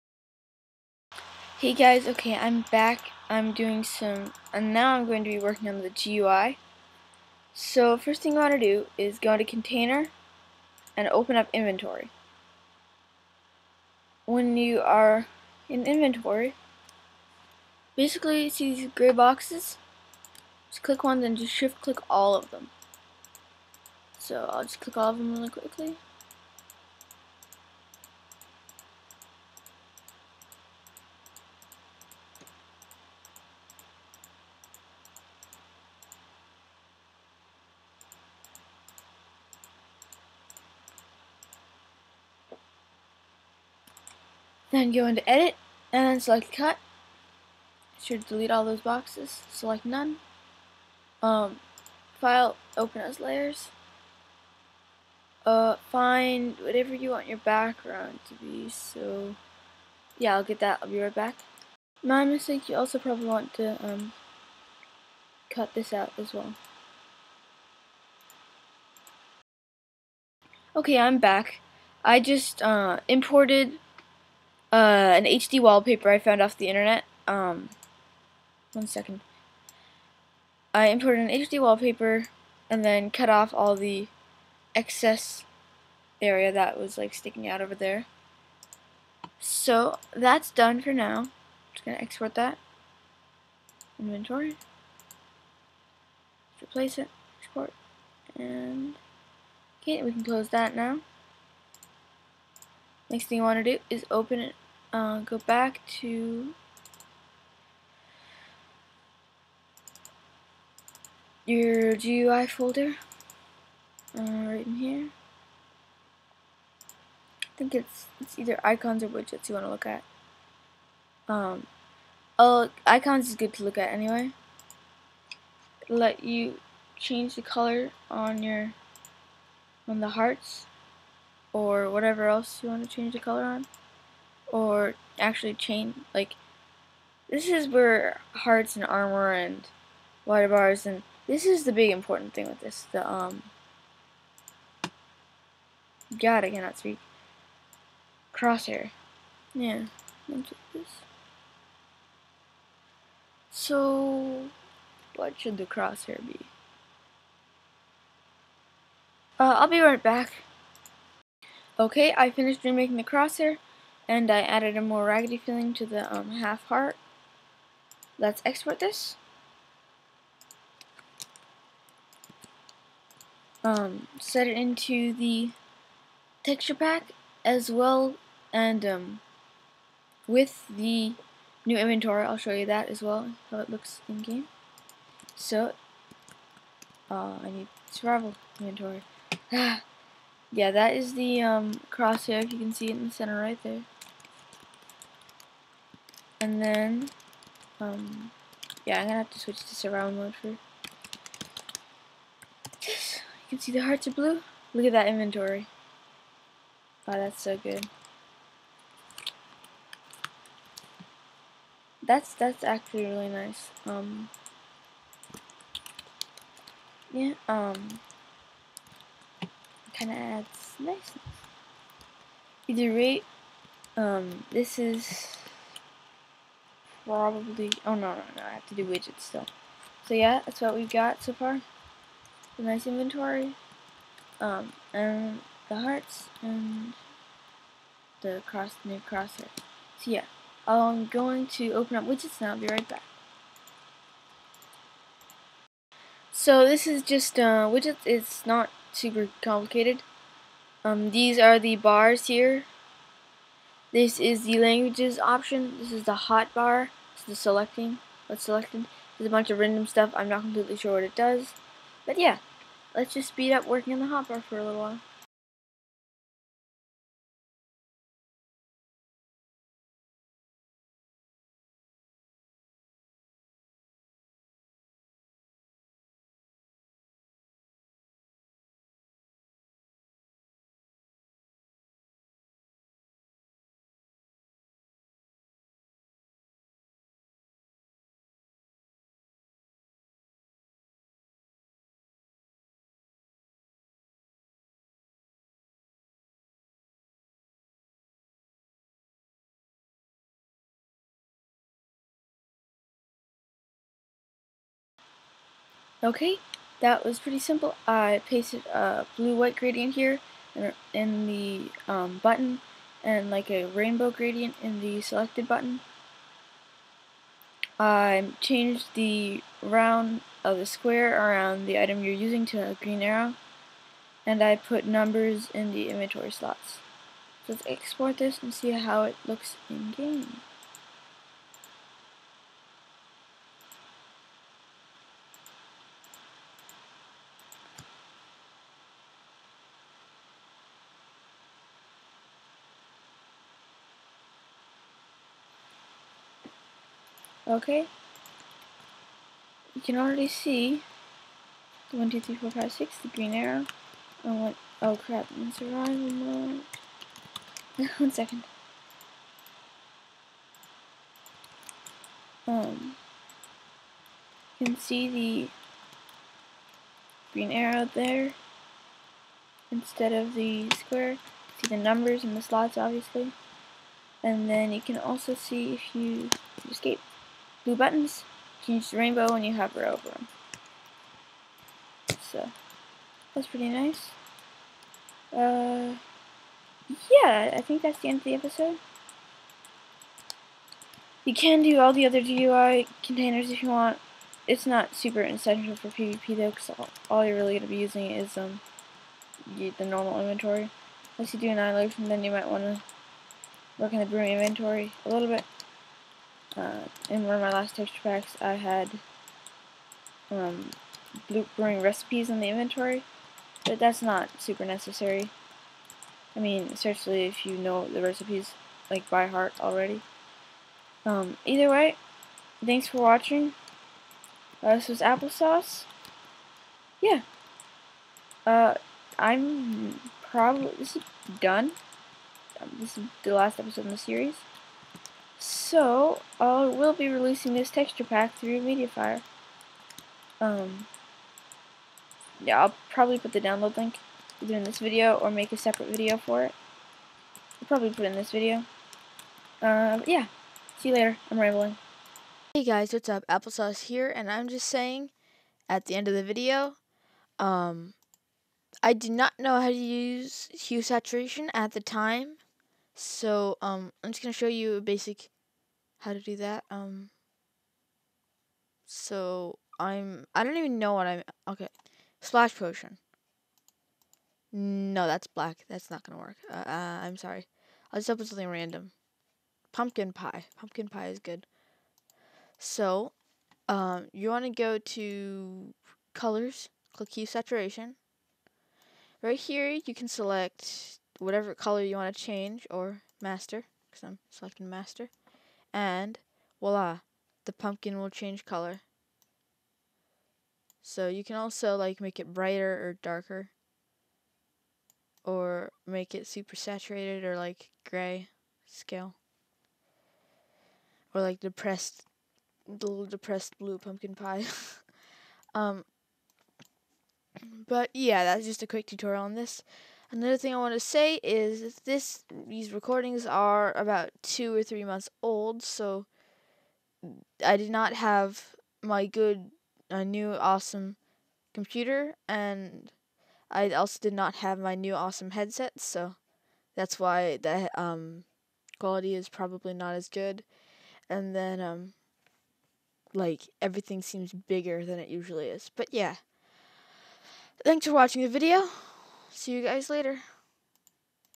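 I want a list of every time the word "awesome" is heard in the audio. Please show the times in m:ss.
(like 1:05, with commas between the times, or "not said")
8:50, 8:54.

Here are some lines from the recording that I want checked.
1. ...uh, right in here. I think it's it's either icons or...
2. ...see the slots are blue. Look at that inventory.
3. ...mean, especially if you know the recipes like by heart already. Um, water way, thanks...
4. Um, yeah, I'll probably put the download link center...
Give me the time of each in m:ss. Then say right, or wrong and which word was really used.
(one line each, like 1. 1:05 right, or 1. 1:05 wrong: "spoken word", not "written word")
1. 1:54 right
2. 3:23 wrong: "hearts", not "slots"
3. 6:56 wrong: "either", not "water"
4. 7:20 wrong: "either", not "center".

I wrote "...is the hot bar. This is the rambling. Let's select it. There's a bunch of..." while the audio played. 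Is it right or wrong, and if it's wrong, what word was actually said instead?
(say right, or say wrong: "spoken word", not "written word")
wrong: "selecting", not "rambling".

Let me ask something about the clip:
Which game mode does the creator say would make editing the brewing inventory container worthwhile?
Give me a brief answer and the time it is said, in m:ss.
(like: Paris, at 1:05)
Annihilation, at 6:41.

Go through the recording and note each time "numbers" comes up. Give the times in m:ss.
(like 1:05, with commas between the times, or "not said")
5:24, 6:11.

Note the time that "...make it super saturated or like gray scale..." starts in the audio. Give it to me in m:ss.
8:25.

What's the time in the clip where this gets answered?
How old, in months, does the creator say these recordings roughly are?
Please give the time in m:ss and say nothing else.
8:44.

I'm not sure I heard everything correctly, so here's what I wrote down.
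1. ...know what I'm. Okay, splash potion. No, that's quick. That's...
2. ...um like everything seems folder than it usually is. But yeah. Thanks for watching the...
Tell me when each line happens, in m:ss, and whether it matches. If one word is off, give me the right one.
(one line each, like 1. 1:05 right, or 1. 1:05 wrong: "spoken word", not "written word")
1. 7:50 wrong: "black", not "quick"
2. 9:01 wrong: "bigger", not "folder".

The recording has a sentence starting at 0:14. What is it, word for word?
When you are in inventory, basically see these gray boxes?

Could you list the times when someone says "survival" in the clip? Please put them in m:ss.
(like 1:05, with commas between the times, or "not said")
3:07, 5:55.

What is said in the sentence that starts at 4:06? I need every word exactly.
So this is just uh, widgets, it's not super complicated.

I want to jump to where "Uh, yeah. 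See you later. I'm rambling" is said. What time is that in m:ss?
7:29.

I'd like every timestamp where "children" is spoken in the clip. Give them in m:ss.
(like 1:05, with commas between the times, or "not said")
not said.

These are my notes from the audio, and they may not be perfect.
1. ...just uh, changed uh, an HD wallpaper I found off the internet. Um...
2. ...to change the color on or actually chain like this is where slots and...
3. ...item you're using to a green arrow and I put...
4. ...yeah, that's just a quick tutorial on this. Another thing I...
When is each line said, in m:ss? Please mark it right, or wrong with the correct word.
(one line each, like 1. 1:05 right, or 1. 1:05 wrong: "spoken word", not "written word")
1. 1:12 wrong: "imported", not "changed"
2. 2:12 wrong: "hearts", not "slots"
3. 5:21 right
4. 8:37 right.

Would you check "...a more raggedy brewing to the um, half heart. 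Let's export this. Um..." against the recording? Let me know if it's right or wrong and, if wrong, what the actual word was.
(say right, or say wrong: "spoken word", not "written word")
wrong: "feeling", not "brewing".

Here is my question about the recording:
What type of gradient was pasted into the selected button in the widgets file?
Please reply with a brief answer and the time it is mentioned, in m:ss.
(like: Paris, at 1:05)
Rainbow gradient, at 5:13.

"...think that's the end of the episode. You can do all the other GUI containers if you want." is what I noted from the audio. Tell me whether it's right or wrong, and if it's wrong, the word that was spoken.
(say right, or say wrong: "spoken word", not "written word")
right.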